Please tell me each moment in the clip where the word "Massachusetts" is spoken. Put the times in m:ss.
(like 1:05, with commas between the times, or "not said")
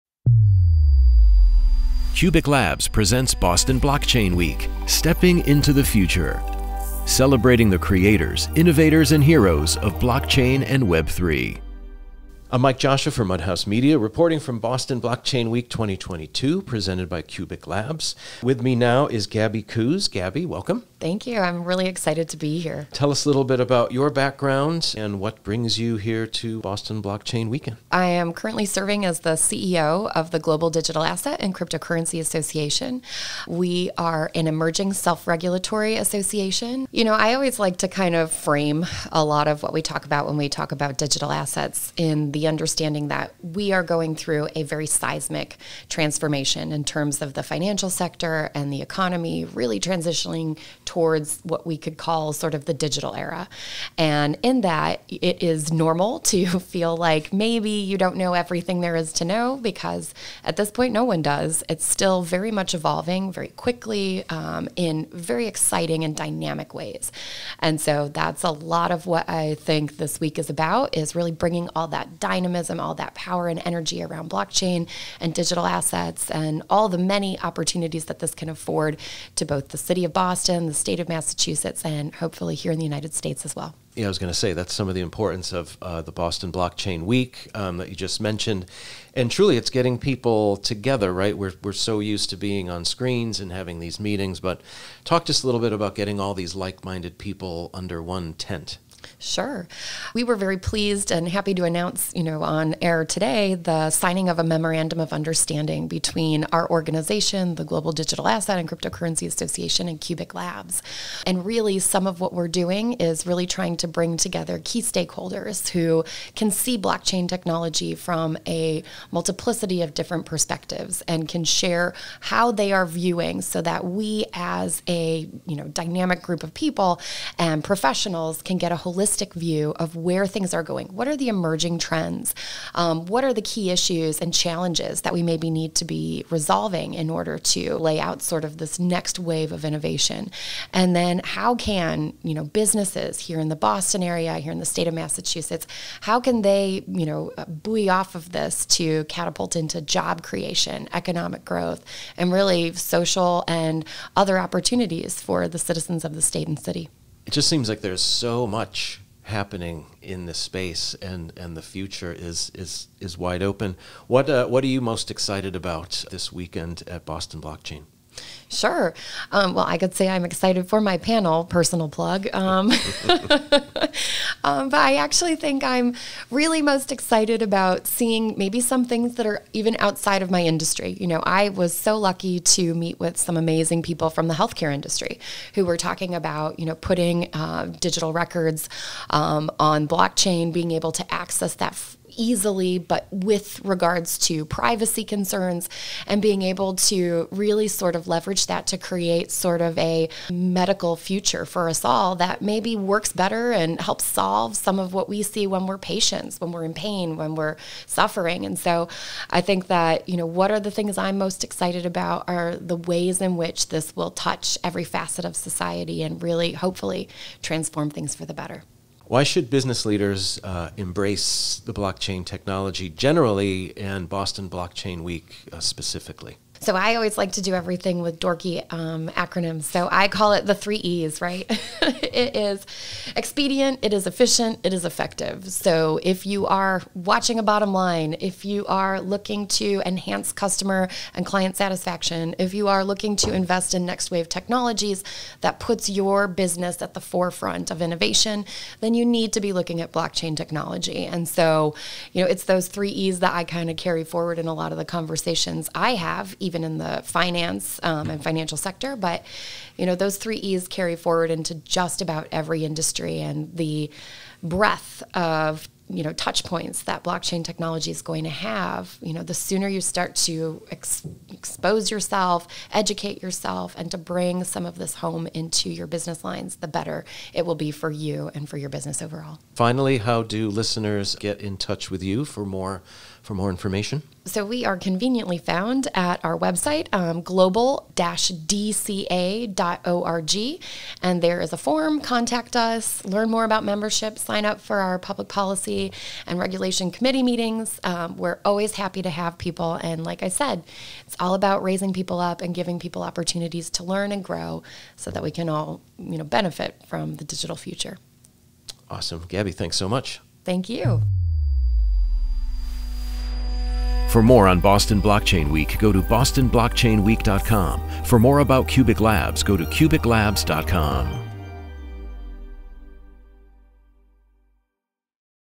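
1:21, 2:24.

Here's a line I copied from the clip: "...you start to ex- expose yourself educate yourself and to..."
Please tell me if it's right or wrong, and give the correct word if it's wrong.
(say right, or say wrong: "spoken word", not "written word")
right.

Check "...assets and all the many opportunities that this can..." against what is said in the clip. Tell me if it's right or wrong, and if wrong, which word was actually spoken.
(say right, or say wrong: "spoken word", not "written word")
right.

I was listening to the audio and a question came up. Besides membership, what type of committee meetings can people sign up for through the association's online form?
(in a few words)
public policy and regulation.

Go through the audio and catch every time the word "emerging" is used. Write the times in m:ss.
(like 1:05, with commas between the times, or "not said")
0:34, 2:11.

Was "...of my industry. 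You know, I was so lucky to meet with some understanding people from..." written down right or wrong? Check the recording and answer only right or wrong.
wrong.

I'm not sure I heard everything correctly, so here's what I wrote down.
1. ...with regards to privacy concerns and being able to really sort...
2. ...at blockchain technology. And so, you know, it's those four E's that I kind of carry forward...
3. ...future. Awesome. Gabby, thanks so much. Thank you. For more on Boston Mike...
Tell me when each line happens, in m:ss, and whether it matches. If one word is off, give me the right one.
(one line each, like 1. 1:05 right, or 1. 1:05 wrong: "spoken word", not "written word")
1. 3:13 right
2. 4:09 wrong: "three", not "four"
3. 5:07 wrong: "Blockchain", not "Mike".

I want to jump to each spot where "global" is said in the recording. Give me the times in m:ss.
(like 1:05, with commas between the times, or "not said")
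0:30, 1:47, 4:47.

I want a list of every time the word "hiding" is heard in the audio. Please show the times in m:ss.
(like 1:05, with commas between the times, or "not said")
not said.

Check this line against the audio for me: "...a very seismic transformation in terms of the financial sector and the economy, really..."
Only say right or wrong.
right.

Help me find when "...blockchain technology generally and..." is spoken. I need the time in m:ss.
3:41.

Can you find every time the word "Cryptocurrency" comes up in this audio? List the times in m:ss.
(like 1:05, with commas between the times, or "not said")
0:31, 1:48.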